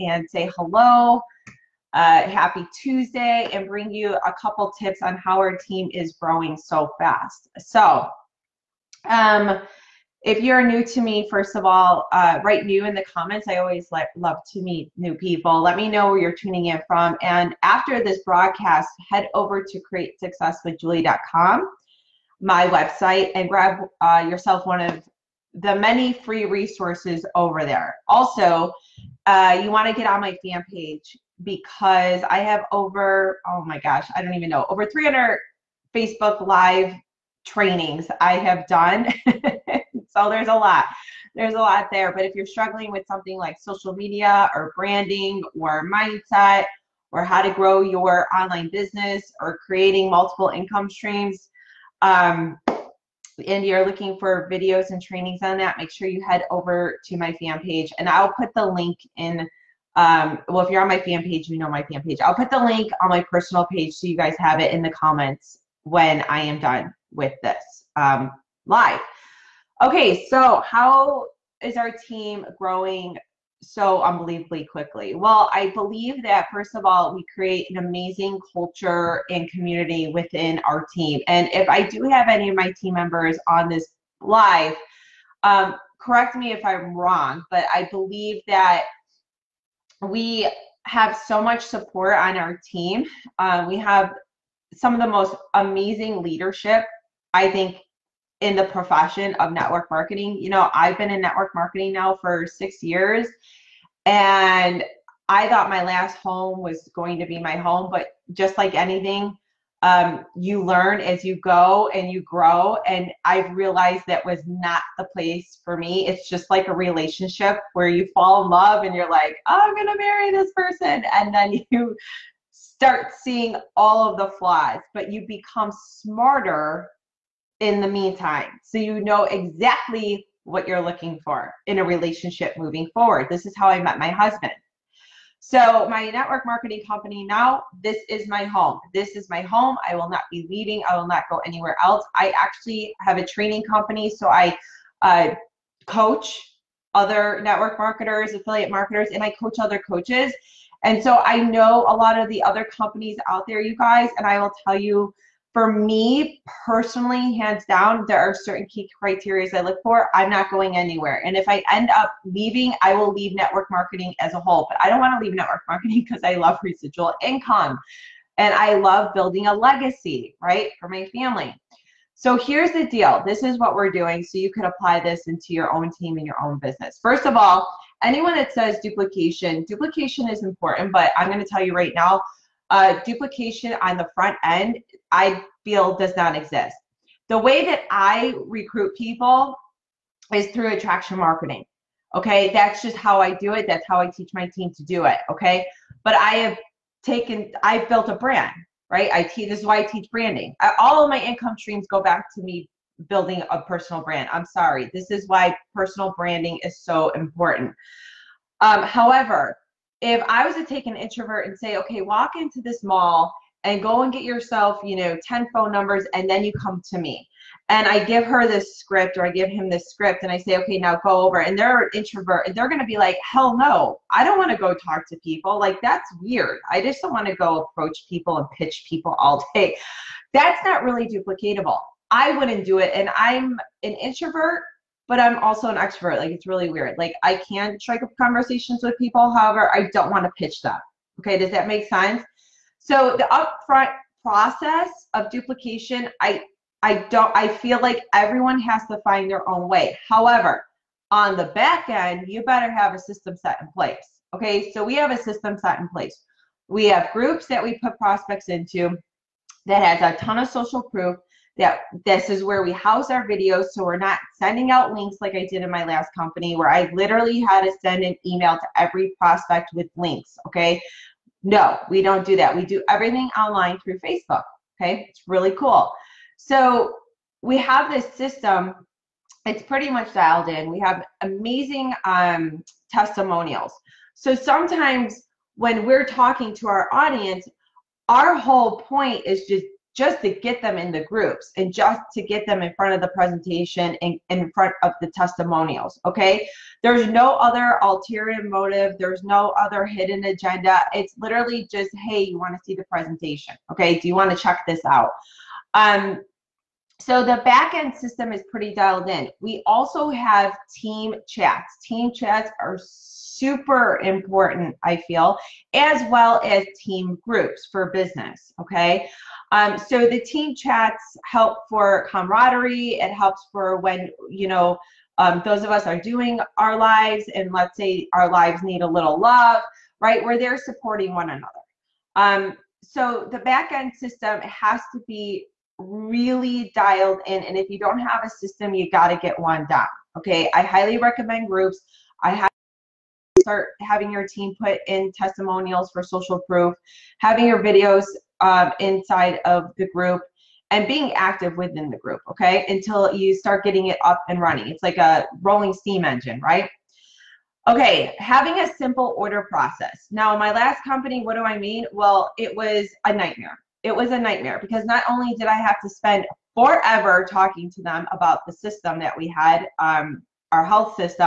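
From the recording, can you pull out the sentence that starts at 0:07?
So, um, if you're new to me, first of all, uh, write new in the comments.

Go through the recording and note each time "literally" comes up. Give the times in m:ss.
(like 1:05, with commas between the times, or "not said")
4:26, 5:01.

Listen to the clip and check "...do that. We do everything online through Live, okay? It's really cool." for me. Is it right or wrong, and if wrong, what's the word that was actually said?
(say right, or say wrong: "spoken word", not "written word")
wrong: "Facebook", not "Live".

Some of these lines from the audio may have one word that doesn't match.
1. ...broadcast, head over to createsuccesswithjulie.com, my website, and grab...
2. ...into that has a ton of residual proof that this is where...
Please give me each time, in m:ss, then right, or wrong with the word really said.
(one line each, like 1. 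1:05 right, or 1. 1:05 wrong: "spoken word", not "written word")
1. 0:18 right
2. 4:18 wrong: "social", not "residual".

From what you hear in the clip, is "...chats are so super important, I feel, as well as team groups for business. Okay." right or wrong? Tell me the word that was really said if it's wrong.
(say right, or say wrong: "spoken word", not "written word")
right.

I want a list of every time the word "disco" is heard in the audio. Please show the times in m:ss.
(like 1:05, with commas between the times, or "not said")
not said.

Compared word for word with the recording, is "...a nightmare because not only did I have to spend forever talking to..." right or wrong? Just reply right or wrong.
right.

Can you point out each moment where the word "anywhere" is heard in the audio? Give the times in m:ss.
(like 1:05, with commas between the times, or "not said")
2:21, 2:40.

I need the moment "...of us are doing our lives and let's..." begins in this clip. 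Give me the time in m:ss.
5:25.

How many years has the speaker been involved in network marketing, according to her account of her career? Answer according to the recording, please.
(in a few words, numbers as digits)
6.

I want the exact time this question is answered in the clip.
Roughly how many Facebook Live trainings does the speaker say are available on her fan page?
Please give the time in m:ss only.
0:34.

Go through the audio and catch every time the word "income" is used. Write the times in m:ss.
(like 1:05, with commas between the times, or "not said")
0:50, 2:47, 3:21.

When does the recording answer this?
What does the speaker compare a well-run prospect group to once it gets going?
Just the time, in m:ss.
5:55.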